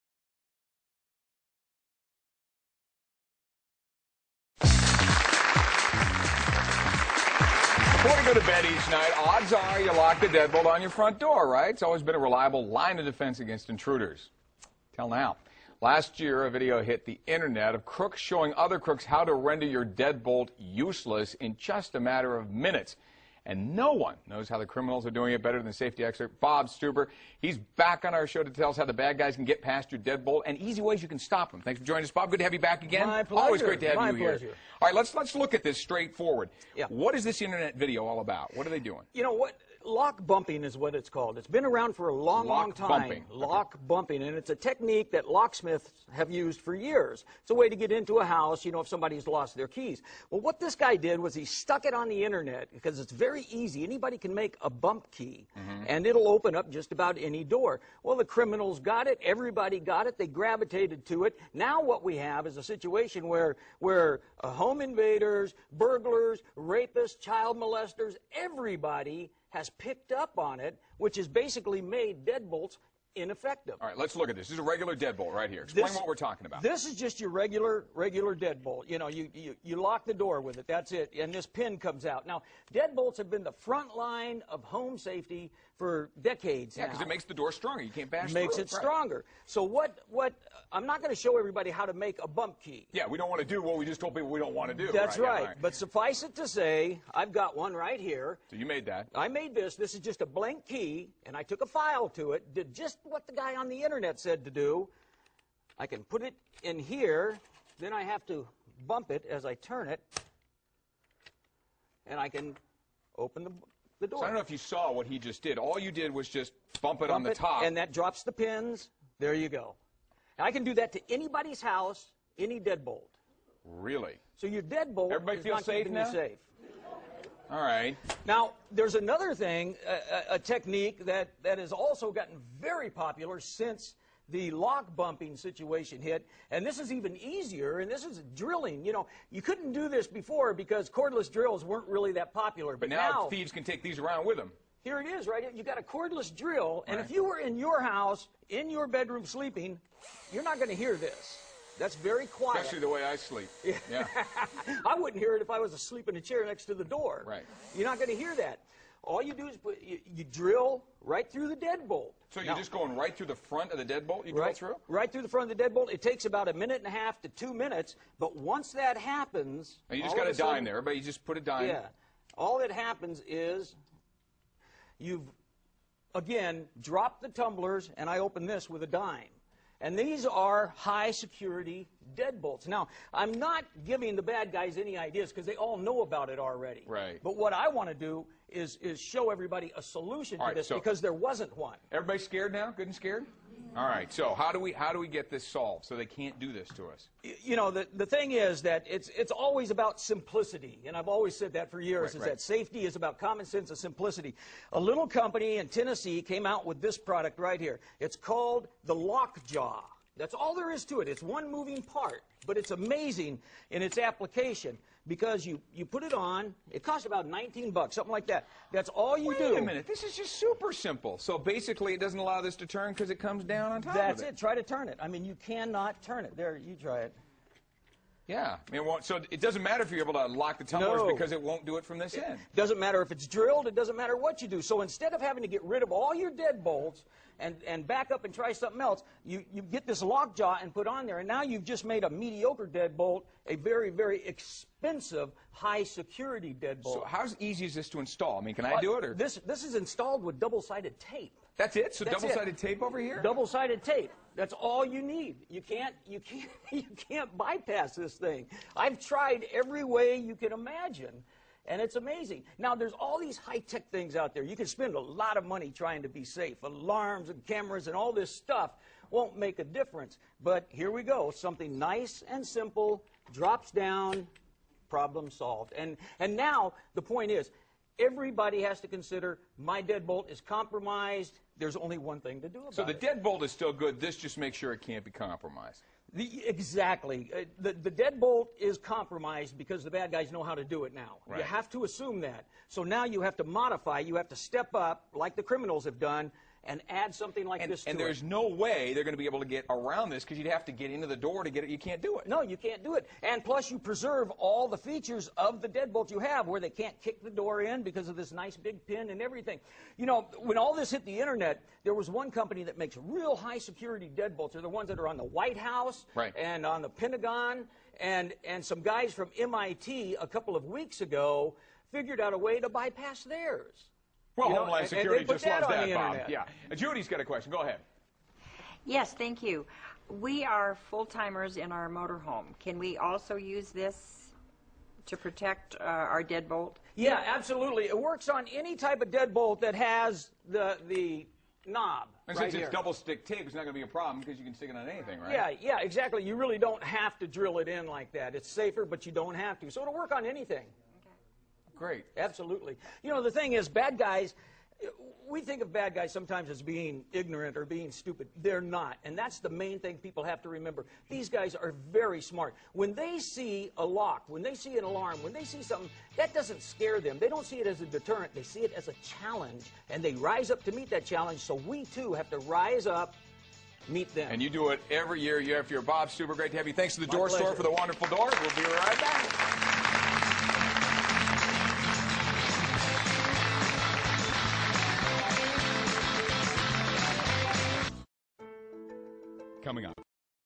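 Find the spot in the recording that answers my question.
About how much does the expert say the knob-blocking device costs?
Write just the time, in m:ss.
3:37.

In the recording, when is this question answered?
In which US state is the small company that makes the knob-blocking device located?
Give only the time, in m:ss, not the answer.
3:25.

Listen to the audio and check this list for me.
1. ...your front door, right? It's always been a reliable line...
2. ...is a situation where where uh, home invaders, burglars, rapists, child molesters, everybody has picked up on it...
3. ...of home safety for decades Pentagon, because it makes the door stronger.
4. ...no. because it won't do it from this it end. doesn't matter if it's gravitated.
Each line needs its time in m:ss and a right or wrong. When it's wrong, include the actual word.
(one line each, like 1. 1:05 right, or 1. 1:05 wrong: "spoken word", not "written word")
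1. 0:10 right
2. 1:02 right
3. 1:24 wrong: "Yeah", not "Pentagon"
4. 3:51 wrong: "drilled", not "gravitated".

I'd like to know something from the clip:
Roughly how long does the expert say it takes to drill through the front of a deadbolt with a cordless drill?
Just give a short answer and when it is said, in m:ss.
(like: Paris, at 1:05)
A minute and a half to two minutes, at 2:46.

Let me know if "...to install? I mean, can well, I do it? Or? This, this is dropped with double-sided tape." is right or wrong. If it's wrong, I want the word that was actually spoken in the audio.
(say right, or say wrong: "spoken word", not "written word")
wrong: "installed", not "dropped".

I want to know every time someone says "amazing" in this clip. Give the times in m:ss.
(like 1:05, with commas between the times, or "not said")
3:32, 4:21.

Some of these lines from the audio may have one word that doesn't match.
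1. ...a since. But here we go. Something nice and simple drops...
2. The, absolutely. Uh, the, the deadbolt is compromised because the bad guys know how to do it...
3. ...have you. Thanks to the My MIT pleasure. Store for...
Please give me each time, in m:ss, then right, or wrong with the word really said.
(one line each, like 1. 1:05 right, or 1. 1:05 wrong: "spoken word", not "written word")
1. 4:29 wrong: "difference", not "since"
2. 4:46 wrong: "exactly", not "absolutely"
3. 6:16 wrong: "Door", not "MIT".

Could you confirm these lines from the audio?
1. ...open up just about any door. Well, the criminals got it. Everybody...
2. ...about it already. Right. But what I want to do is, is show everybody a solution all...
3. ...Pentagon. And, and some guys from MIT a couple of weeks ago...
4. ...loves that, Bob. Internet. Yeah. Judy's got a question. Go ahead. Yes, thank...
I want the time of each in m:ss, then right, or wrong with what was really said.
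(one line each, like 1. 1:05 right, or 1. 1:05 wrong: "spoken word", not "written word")
1. 0:56 right
2. 3:06 right
3. 5:16 right
4. 5:25 right.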